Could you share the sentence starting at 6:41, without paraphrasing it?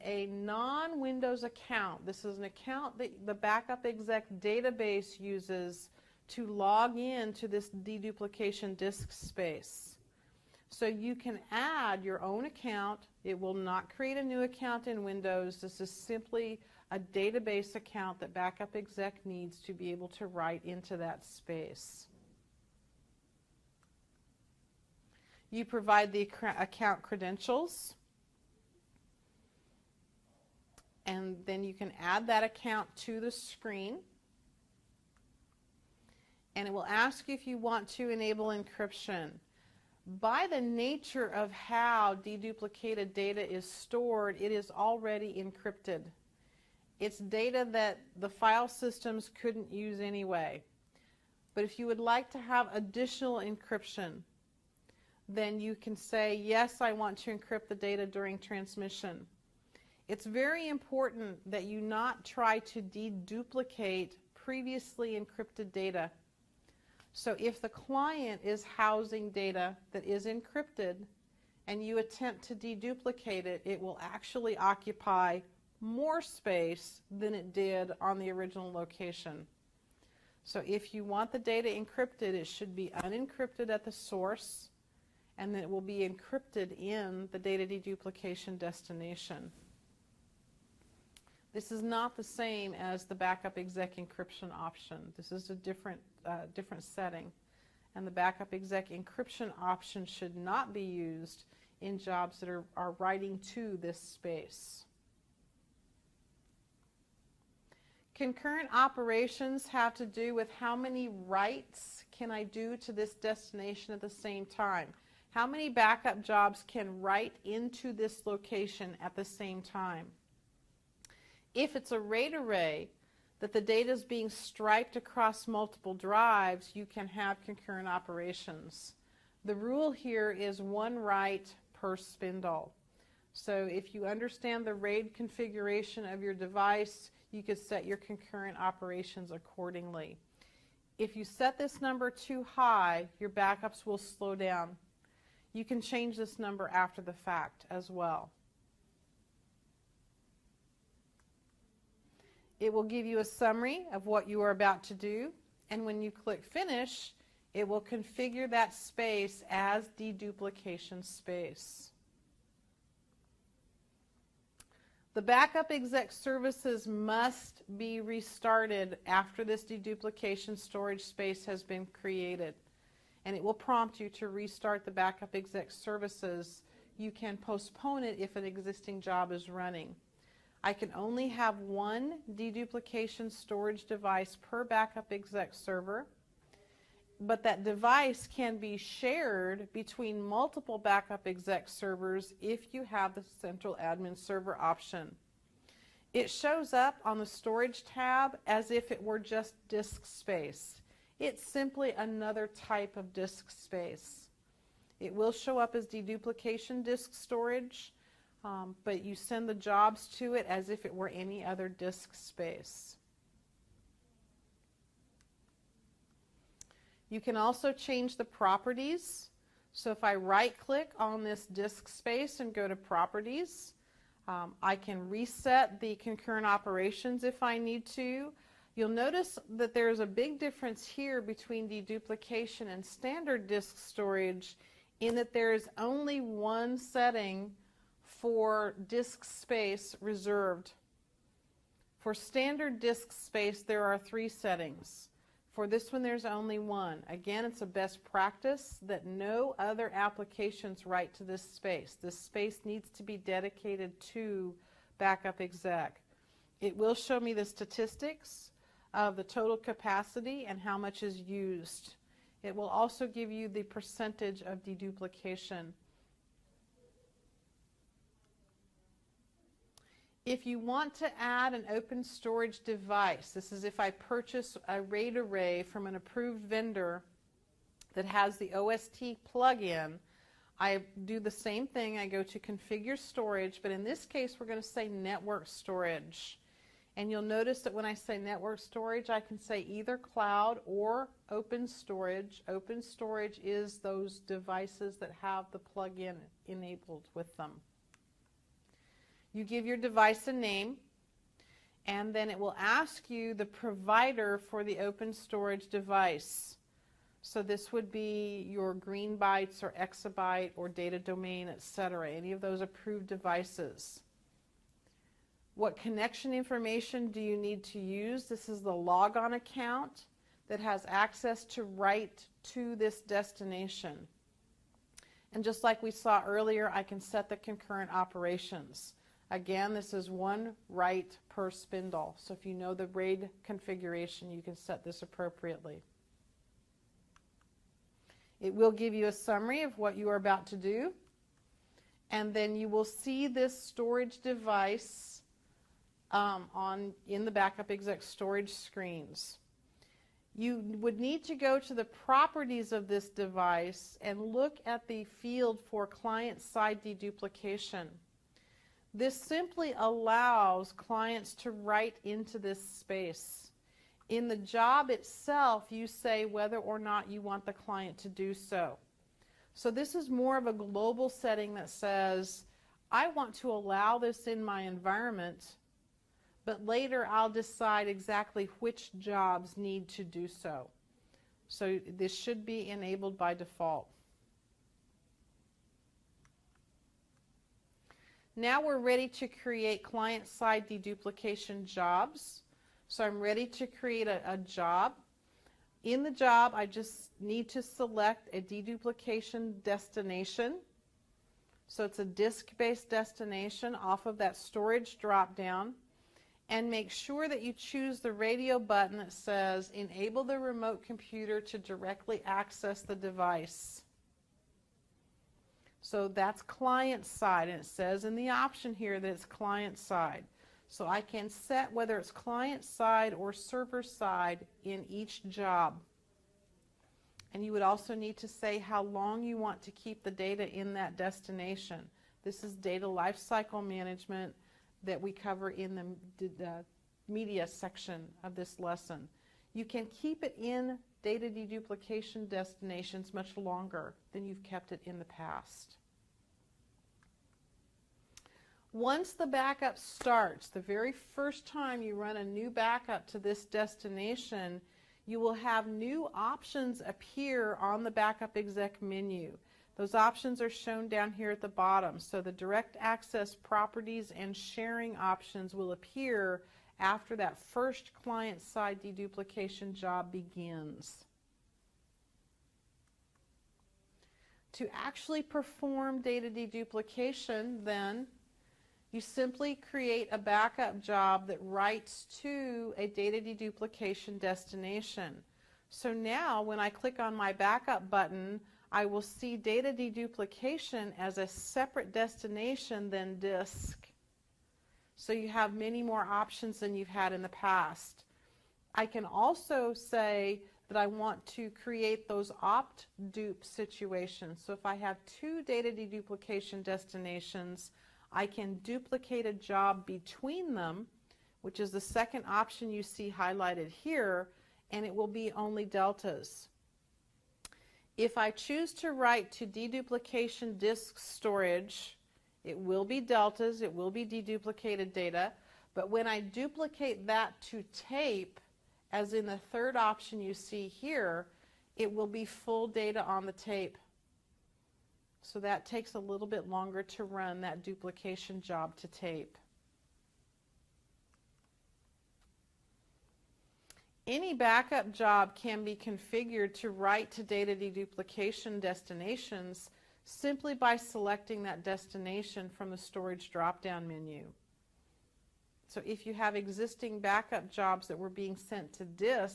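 So it's a disk-based destination off of that storage drop-down.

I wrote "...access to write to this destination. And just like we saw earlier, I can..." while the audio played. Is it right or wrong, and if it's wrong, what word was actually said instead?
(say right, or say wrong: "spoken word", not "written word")
right.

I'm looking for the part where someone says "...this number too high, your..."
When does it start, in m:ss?
2:21.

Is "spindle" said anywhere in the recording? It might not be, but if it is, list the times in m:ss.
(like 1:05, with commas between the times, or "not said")
2:11, 5:31.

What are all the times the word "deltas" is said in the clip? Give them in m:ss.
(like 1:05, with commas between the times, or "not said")
8:35, 8:42.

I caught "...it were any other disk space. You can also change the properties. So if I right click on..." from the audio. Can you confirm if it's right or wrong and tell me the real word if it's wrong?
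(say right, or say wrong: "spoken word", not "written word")
right.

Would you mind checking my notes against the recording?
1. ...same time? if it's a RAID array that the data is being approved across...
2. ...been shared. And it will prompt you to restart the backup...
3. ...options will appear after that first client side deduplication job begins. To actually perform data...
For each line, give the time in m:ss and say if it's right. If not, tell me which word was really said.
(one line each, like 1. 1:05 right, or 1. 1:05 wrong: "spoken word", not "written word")
1. 1:59 wrong: "striped", not "approved"
2. 2:51 wrong: "created", not "shared"
3. 7:44 right.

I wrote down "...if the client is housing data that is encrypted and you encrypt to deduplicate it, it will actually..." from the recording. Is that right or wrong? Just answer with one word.
wrong.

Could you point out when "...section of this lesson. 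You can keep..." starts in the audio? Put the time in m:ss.
7:17.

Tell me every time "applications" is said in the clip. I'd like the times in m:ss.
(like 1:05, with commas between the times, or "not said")
4:09.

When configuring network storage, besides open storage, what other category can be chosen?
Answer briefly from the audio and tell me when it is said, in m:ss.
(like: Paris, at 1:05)
Cloud, at 4:49.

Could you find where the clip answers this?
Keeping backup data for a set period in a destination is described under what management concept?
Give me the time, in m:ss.
7:12.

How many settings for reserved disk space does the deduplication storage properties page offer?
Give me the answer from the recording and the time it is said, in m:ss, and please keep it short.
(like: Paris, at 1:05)
1, at 3:55.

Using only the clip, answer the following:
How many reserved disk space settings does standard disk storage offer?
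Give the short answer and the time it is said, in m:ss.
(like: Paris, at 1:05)
3, at 4:03.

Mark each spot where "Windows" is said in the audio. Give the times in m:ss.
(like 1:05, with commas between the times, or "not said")
0:00, 0:15.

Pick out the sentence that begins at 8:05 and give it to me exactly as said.
So now when I click on my backup button, I will see data deduplication as a separate destination than disk.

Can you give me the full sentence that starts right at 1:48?
Concurrent operations have to do with how many writes can I do to this destination at the same time?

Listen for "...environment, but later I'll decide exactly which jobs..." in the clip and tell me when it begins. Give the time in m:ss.
6:14.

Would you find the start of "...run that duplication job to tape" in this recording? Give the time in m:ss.
8:57.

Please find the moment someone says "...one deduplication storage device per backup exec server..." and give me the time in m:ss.
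3:01.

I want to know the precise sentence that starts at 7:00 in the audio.
So I can set whether it's client side or server side in each job.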